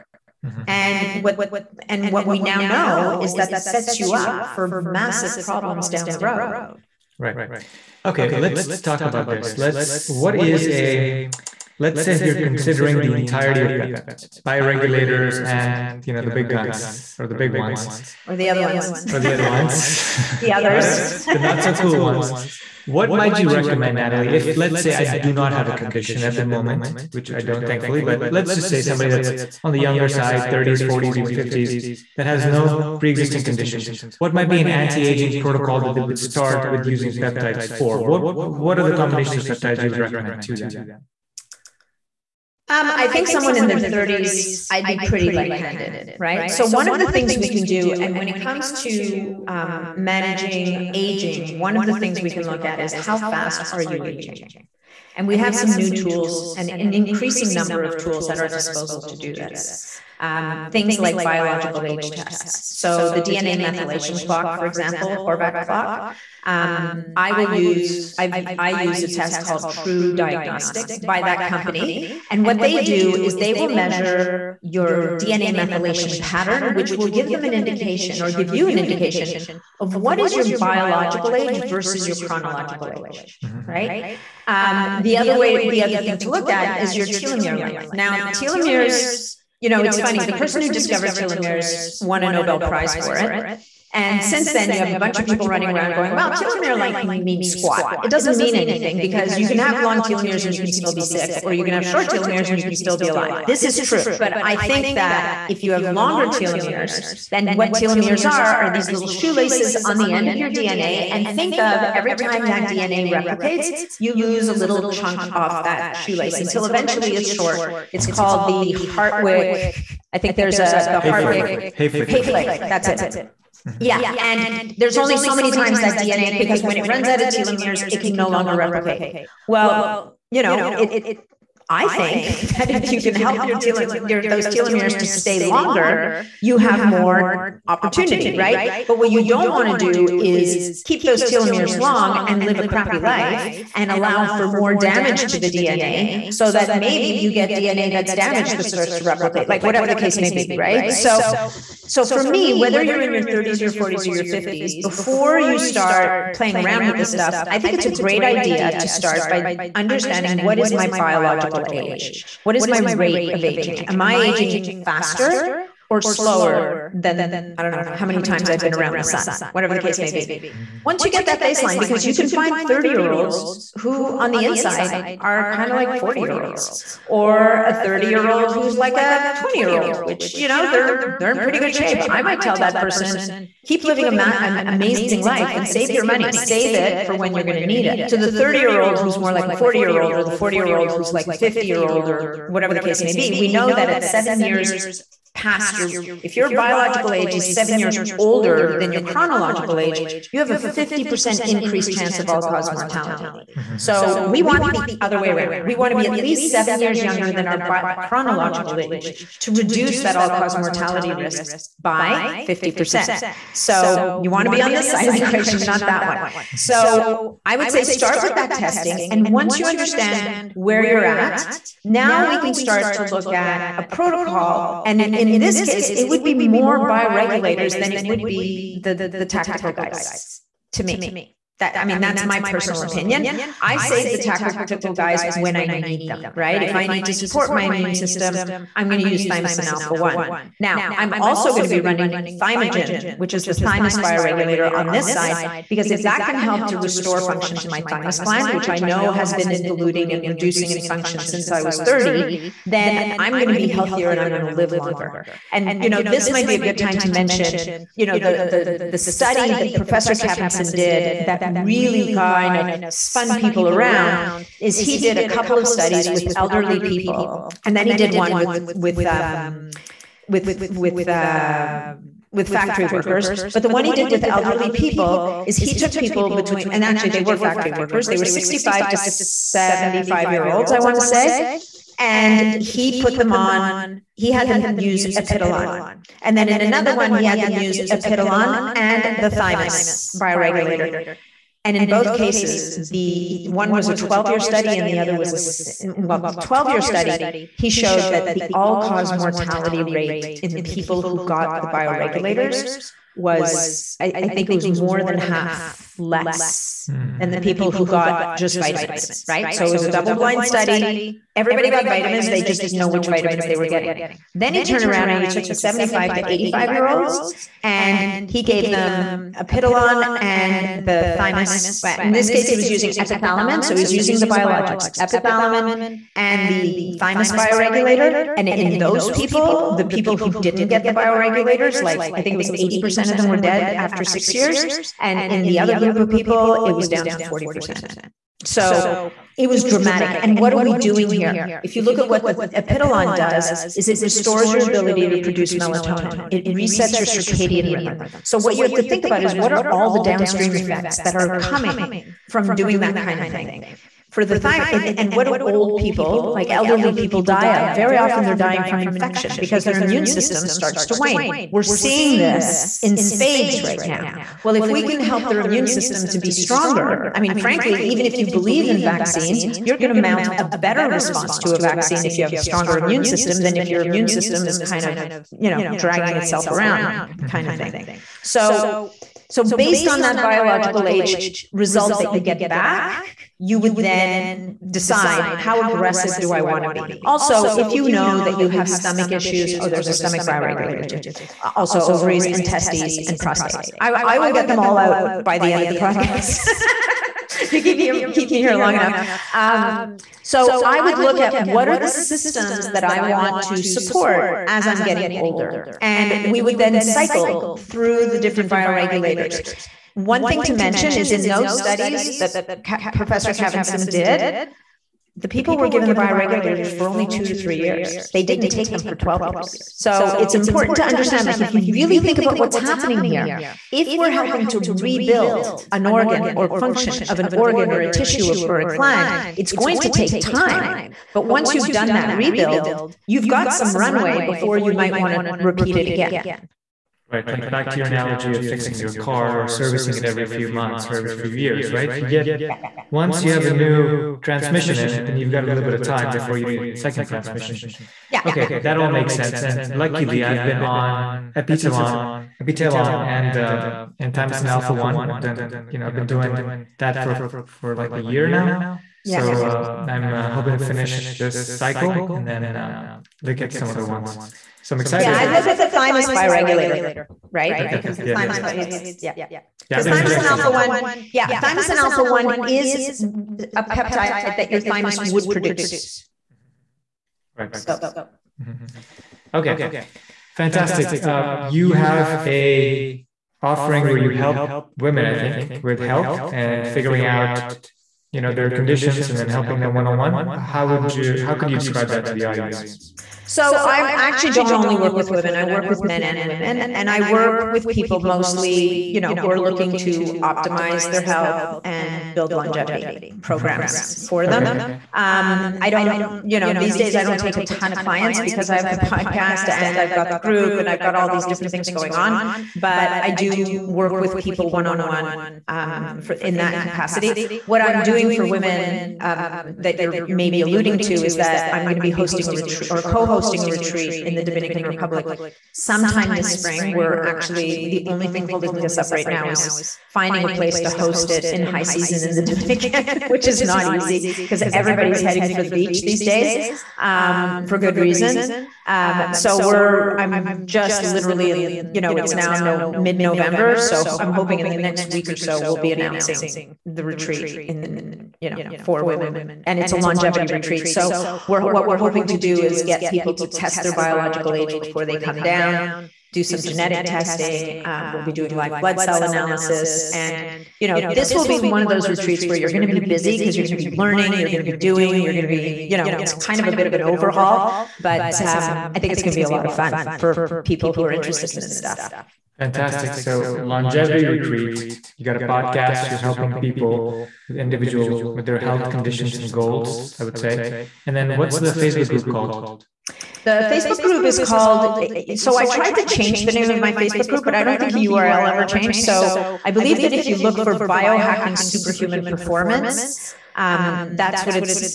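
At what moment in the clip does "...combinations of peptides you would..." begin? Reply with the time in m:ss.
0:38.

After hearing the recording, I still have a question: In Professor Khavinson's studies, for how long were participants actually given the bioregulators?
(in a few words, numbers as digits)
2 to 3 years.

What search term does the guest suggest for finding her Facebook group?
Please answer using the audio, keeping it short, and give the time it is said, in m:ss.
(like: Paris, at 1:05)
Biohacking superhuman performance, at 9:50.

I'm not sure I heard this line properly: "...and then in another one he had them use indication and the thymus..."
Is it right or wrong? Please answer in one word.
wrong.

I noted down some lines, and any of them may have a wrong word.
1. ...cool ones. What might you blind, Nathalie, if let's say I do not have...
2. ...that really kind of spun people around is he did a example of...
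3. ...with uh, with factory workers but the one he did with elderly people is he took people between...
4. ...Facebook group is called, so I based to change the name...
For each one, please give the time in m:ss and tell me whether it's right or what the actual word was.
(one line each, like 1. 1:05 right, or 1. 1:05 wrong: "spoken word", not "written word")
1. 0:21 wrong: "recommend", not "blind"
2. 4:21 wrong: "couple", not "example"
3. 4:30 right
4. 9:43 wrong: "tried", not "based".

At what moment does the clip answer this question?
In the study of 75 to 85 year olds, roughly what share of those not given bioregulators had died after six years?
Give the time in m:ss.
5:32.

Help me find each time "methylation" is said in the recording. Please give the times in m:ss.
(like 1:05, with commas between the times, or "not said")
1:03, 1:15.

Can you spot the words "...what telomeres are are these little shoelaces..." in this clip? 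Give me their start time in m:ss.
1:47.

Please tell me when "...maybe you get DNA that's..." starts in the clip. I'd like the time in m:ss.
2:26.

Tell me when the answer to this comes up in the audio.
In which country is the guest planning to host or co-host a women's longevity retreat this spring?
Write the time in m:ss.
8:44.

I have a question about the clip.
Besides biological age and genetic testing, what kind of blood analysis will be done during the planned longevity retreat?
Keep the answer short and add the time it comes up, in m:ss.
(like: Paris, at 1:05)
Live blood cell analysis, at 9:18.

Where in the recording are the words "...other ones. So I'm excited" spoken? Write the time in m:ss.
7:43.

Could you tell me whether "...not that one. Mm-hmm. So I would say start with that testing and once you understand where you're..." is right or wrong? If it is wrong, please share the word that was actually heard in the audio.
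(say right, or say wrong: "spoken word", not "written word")
right.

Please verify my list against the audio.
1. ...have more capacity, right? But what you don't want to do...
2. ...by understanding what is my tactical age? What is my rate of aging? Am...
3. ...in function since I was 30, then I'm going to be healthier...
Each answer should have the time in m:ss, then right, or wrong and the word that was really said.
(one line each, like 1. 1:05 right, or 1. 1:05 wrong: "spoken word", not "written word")
1. 2:16 wrong: "opportunity", not "capacity"
2. 2:39 wrong: "biological", not "tactical"
3. 4:10 right.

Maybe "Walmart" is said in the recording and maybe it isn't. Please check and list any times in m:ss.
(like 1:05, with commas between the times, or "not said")
not said.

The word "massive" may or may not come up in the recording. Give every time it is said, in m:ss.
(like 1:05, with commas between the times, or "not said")
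0:04.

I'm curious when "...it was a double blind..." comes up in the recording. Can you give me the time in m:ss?
5:09.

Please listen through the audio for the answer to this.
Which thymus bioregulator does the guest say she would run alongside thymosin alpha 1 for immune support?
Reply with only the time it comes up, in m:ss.
4:02.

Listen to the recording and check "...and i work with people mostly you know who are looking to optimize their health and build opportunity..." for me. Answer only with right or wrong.
wrong.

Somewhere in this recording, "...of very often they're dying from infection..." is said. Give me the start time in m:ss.
5:57.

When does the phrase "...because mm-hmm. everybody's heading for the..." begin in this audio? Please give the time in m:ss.
8:54.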